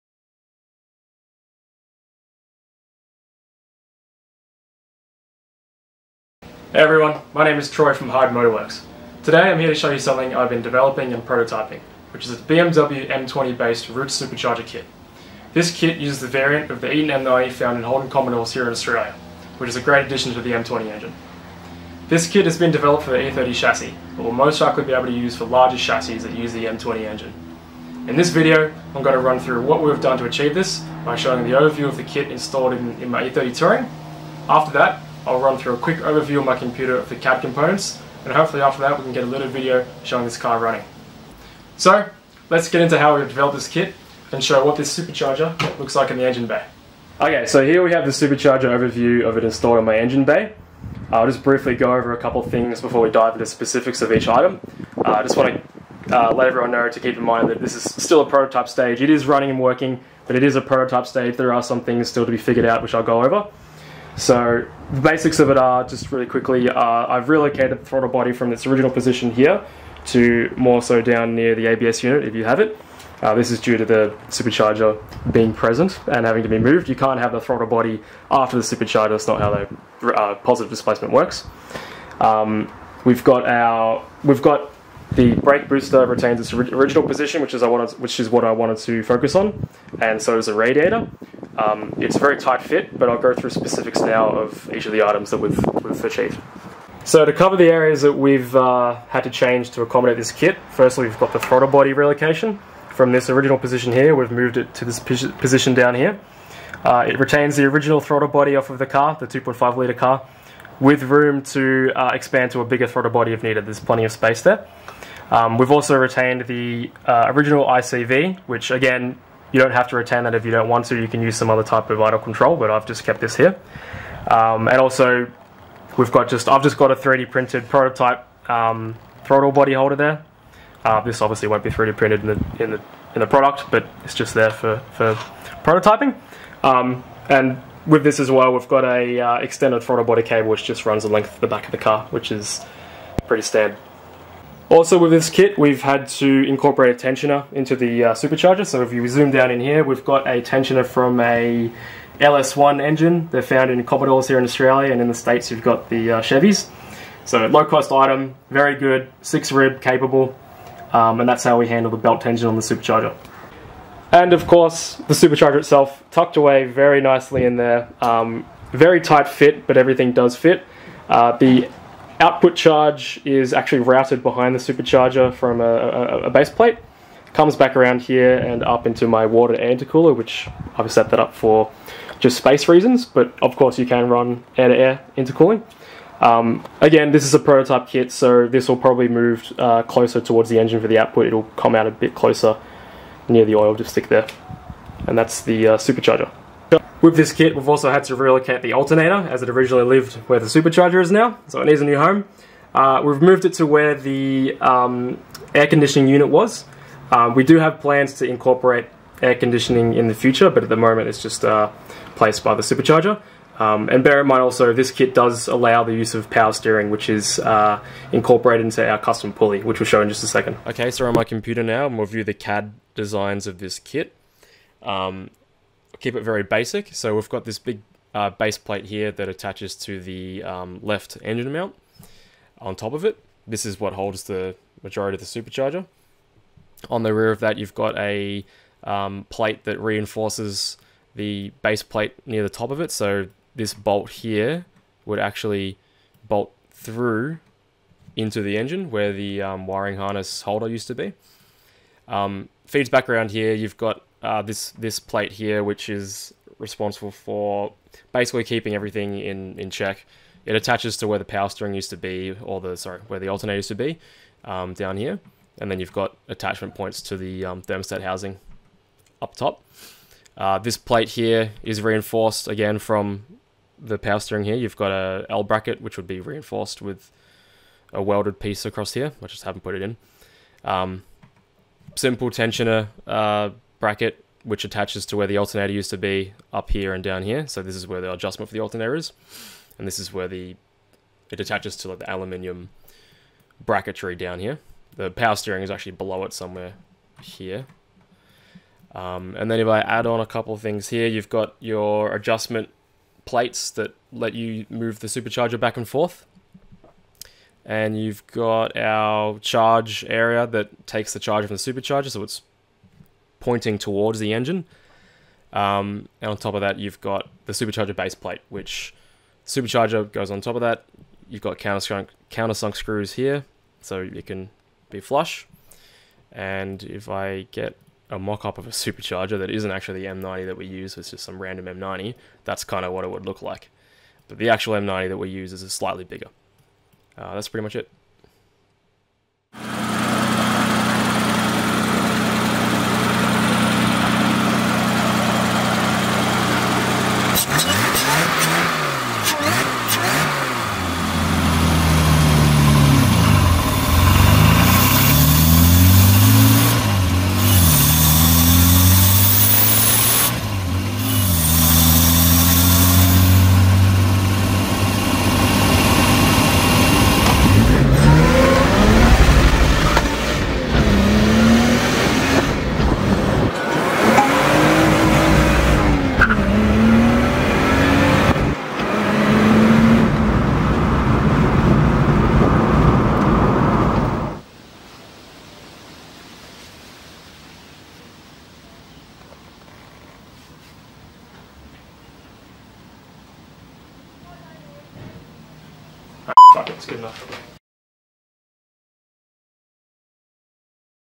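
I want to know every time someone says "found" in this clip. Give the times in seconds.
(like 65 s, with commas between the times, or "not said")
17 s, 153 s.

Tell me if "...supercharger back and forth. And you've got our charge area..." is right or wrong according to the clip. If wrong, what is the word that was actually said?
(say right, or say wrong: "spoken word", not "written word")
right.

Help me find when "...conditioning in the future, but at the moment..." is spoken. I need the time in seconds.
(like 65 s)
209 s.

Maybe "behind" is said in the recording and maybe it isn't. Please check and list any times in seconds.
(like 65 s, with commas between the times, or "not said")
174 s.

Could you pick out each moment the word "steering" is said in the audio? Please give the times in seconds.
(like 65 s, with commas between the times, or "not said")
216 s, 261 s, 274 s, 295 s.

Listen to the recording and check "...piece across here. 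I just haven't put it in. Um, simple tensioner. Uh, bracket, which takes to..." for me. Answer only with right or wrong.
wrong.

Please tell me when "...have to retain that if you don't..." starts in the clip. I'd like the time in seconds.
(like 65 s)
119 s.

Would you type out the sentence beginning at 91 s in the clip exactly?
Um, it's a very tight fit, but I'll go through specifics now of each of the items that we've, we've achieved.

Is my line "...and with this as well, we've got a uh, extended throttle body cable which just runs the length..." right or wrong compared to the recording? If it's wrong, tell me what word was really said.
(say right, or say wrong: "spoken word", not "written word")
right.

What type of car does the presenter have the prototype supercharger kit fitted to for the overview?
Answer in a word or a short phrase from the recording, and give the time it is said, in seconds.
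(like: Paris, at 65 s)
E30 Touring, at 33 s.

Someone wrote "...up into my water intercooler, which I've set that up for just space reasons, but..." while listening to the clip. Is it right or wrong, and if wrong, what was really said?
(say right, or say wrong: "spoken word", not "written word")
right.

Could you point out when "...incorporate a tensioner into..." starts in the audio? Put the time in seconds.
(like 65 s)
146 s.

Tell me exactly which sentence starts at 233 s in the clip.
This is what holds the majority of the supercharger.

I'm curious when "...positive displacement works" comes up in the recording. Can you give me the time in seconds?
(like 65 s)
80 s.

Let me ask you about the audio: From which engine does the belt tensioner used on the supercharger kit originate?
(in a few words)
LS1.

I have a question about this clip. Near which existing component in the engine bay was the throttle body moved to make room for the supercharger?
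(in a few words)
ABS unit.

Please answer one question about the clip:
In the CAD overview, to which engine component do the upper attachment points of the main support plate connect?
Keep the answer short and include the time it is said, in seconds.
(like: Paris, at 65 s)
thermostat housing, at 267 s.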